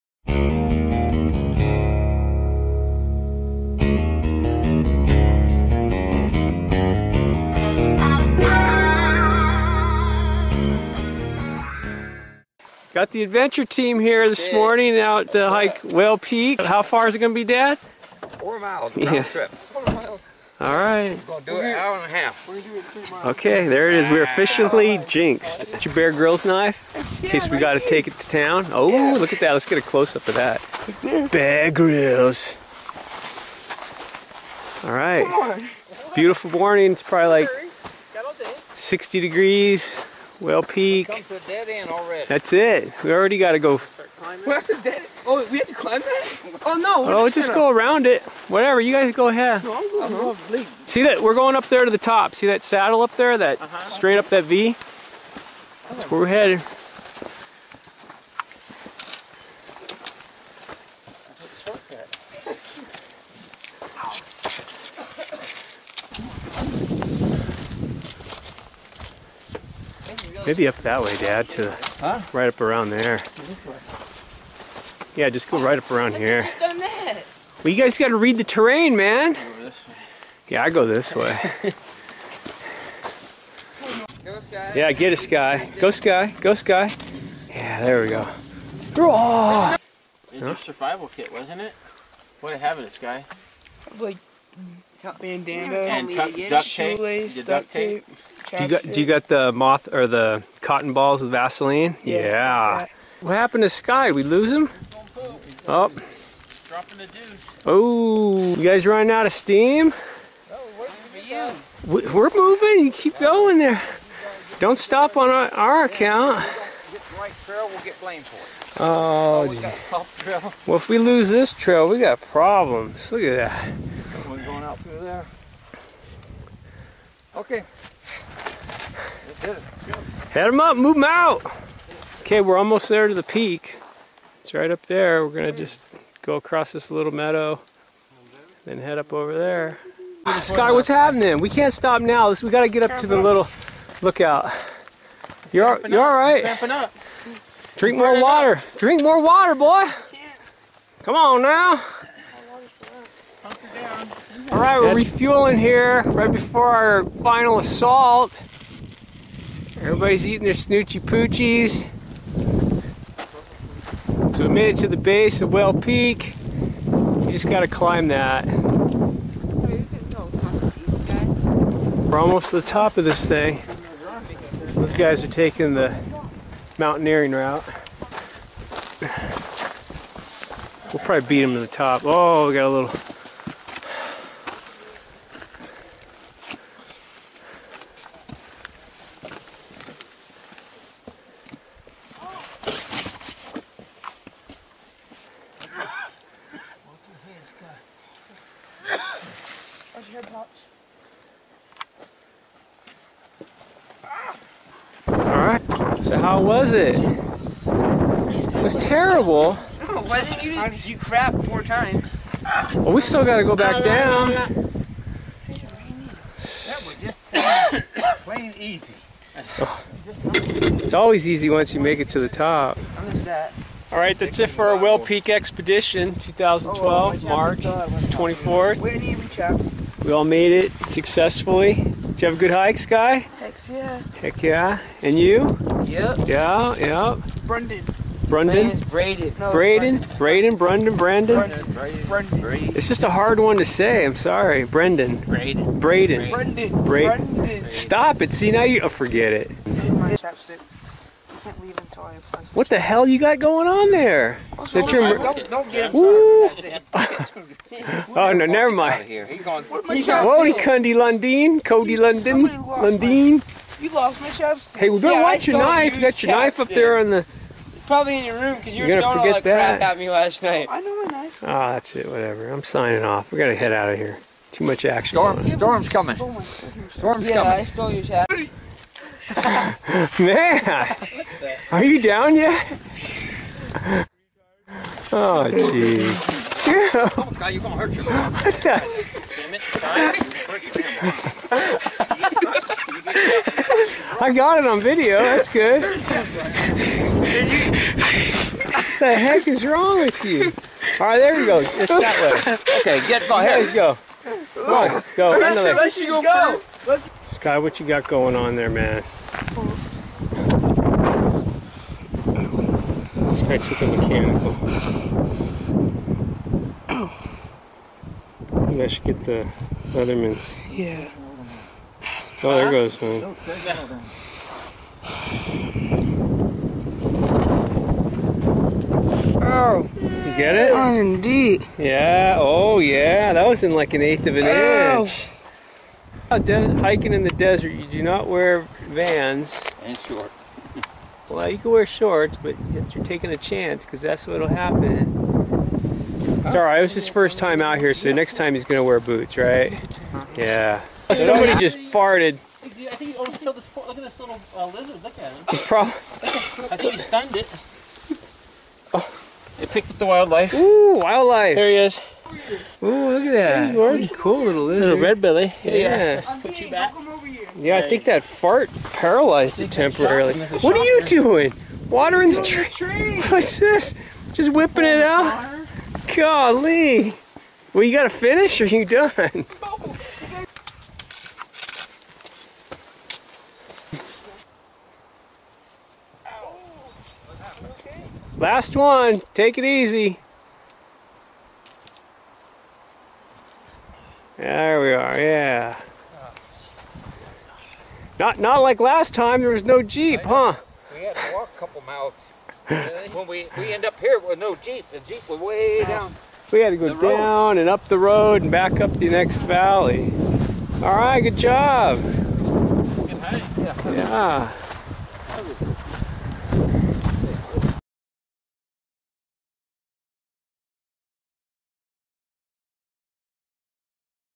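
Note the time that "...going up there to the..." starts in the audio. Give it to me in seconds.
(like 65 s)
51 s.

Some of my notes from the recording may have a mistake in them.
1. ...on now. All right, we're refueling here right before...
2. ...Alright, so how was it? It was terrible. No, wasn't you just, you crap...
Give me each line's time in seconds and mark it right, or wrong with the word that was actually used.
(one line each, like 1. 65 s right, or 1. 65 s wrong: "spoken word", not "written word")
1. 151 s right
2. 205 s right.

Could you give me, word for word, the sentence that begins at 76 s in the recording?
Well, you guys got to read the terrain, man.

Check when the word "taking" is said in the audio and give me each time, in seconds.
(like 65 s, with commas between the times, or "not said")
175 s, 343 s.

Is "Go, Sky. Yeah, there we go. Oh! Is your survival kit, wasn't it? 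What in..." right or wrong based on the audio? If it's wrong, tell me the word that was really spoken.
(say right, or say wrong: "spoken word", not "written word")
right.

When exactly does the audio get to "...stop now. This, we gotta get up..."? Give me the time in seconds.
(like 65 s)
141 s.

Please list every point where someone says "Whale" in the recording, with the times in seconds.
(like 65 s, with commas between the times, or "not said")
15 s, 40 s, 165 s, 224 s.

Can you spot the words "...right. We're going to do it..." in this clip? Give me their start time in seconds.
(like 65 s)
20 s.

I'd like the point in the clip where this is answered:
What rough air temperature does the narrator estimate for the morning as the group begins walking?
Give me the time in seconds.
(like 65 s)
38 s.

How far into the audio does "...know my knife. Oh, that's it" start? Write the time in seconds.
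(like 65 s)
270 s.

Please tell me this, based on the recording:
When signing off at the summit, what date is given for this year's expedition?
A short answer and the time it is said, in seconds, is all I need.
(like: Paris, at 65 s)
March 24th, at 227 s.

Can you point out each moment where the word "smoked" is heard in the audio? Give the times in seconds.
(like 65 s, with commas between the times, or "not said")
not said.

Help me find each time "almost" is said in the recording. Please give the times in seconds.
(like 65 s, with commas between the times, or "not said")
132 s, 172 s, 353 s.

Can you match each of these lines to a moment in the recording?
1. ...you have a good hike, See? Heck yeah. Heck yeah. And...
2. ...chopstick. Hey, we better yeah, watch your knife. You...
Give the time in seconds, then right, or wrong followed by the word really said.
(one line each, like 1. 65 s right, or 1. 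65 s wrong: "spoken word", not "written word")
1. 232 s wrong: "Sky", not "See"
2. 264 s right.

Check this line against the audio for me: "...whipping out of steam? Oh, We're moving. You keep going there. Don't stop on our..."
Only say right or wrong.
wrong.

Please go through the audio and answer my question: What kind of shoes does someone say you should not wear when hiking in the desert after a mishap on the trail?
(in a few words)
Vans.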